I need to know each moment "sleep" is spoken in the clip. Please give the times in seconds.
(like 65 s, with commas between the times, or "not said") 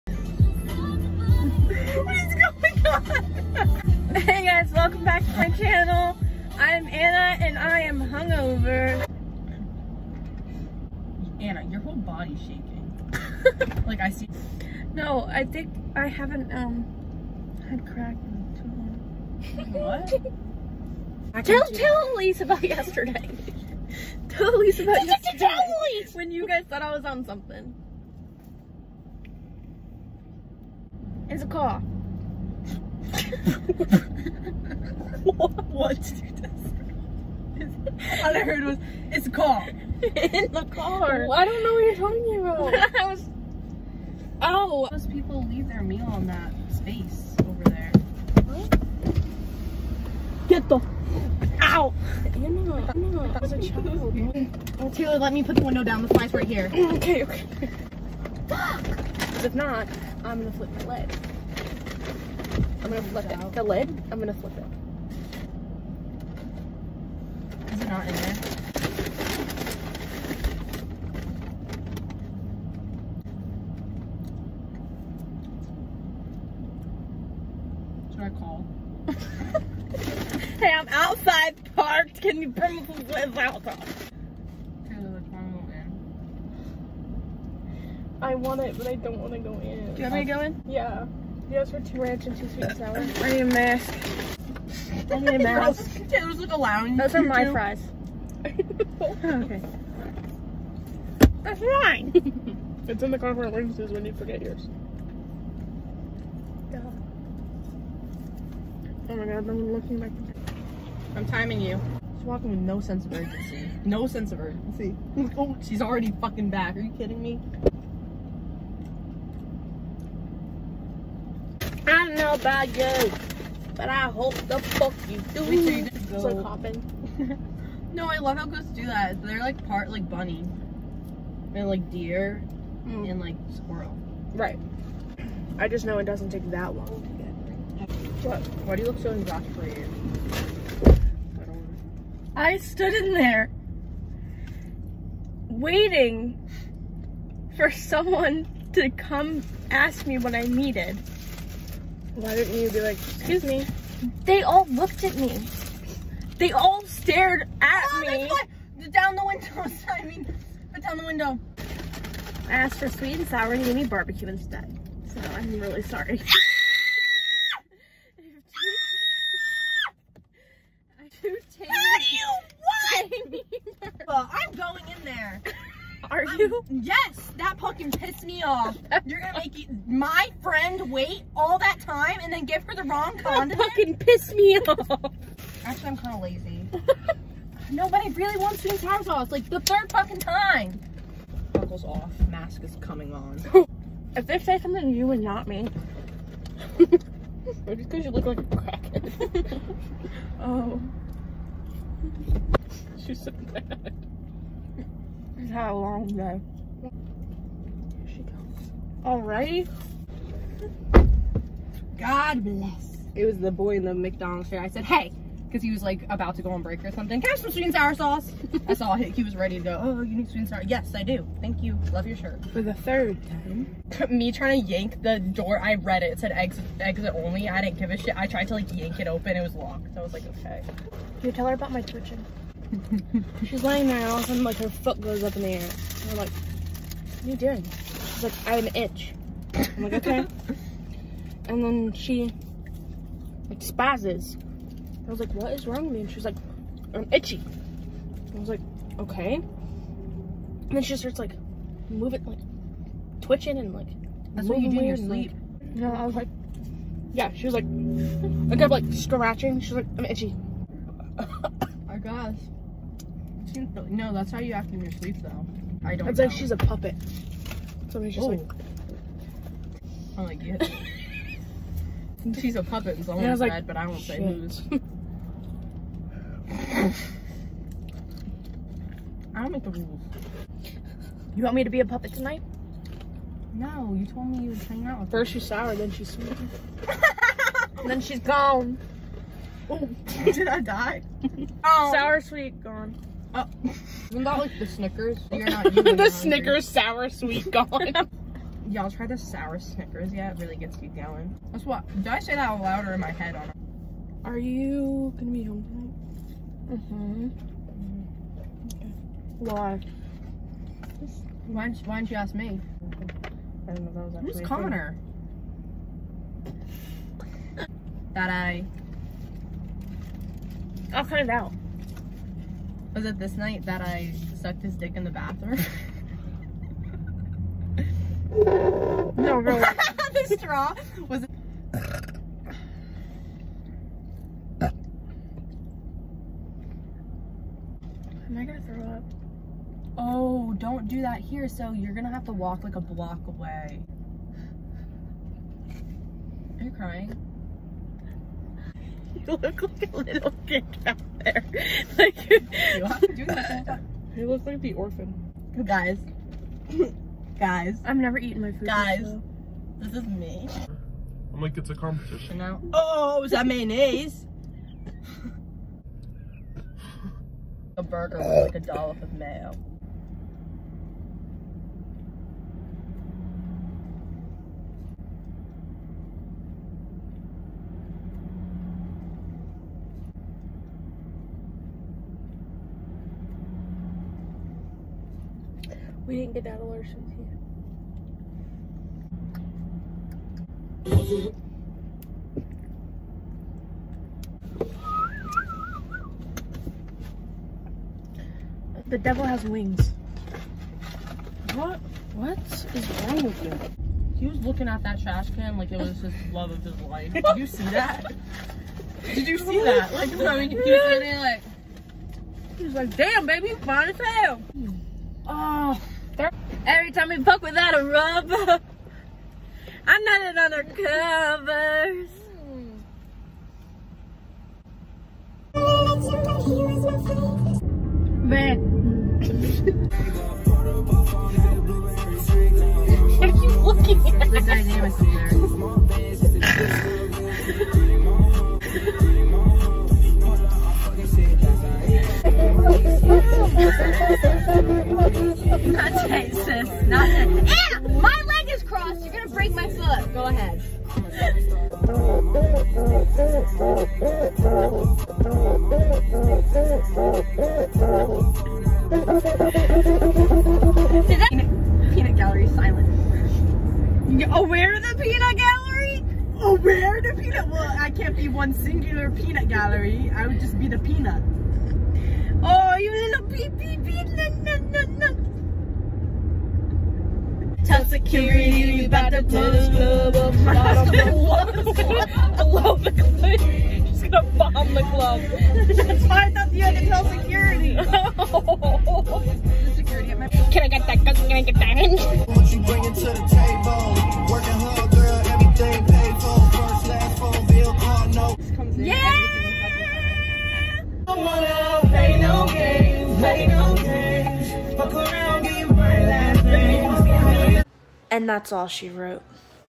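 254 s, 264 s.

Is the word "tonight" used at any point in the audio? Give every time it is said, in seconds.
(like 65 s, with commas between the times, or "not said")
282 s, 305 s.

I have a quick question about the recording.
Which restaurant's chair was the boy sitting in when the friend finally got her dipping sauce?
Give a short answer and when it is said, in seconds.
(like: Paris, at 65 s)
McDonald's, at 213 s.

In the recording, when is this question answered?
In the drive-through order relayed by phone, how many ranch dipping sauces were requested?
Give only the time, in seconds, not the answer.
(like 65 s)
91 s.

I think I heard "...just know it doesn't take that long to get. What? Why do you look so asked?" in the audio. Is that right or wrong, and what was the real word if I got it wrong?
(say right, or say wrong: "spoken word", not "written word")
wrong: "exasperated", not "asked".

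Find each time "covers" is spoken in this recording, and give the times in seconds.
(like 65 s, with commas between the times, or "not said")
420 s.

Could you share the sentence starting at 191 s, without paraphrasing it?
Buckles off, mask is coming on.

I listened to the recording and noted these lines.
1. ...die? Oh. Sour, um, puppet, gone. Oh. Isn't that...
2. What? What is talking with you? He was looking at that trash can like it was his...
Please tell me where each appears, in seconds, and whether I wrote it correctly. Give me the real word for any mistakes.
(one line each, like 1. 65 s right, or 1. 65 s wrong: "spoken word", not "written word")
1. 290 s wrong: "sweet", not "puppet"
2. 401 s wrong: "wrong", not "talking".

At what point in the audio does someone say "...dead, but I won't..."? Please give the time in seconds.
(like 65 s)
273 s.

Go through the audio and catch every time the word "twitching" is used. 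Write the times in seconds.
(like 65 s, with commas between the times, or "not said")
231 s, 253 s.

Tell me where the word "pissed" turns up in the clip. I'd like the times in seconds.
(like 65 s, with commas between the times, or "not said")
177 s, 183 s.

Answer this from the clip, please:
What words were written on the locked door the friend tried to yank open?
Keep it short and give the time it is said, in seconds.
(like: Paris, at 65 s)
exit only, at 226 s.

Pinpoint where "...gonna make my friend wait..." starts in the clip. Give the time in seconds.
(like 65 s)
179 s.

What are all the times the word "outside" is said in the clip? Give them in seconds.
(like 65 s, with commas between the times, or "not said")
80 s.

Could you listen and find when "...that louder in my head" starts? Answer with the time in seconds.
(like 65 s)
302 s.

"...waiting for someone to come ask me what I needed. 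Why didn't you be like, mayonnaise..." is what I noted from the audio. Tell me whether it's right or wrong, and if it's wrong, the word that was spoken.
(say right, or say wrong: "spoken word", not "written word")
wrong: "excuse", not "mayonnaise".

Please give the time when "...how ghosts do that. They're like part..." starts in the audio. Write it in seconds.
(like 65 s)
128 s.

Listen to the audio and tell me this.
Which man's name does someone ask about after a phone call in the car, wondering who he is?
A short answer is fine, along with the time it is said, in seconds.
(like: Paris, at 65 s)
Connor, at 314 s.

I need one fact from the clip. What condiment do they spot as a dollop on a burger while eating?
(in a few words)
mayonnaise.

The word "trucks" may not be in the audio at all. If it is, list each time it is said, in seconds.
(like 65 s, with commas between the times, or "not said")
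not said.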